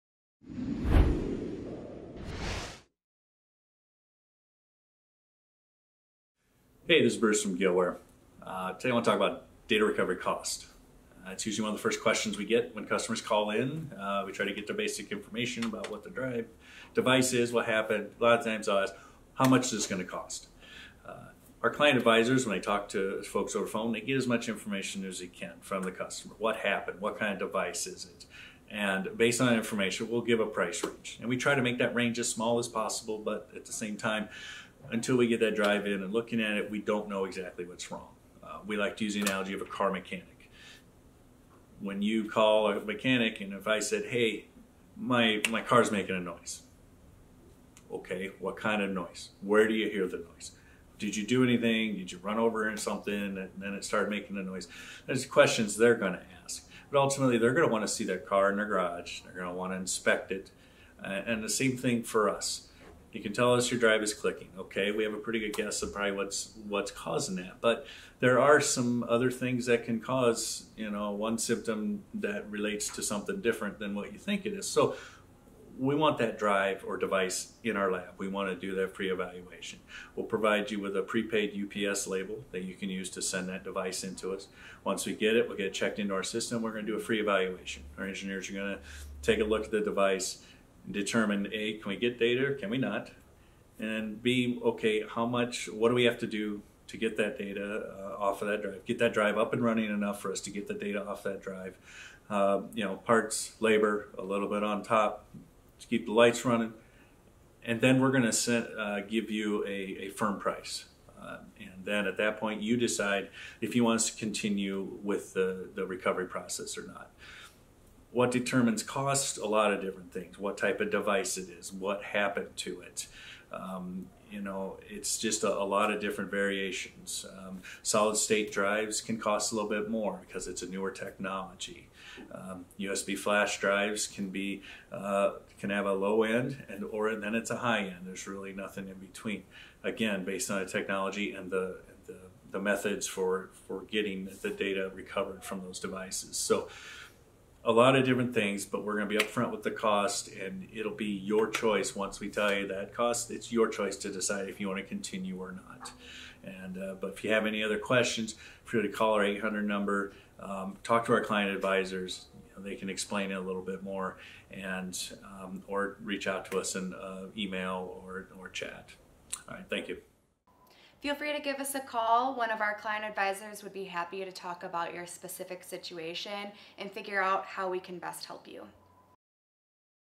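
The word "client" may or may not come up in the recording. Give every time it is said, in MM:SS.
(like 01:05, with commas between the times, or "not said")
00:21, 02:41, 02:52.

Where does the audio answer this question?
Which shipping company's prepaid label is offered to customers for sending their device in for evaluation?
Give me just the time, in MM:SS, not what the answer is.
01:21.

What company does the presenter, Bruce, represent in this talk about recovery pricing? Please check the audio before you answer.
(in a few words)
Gillware.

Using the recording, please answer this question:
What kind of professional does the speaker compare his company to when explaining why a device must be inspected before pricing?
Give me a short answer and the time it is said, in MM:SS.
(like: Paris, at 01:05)
Car mechanic, at 00:39.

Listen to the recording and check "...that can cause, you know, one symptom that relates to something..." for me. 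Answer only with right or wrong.
right.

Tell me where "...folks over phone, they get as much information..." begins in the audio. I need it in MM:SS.
00:23.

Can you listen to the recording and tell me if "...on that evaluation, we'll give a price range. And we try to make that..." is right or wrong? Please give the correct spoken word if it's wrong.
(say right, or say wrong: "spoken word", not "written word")
wrong: "information", not "evaluation".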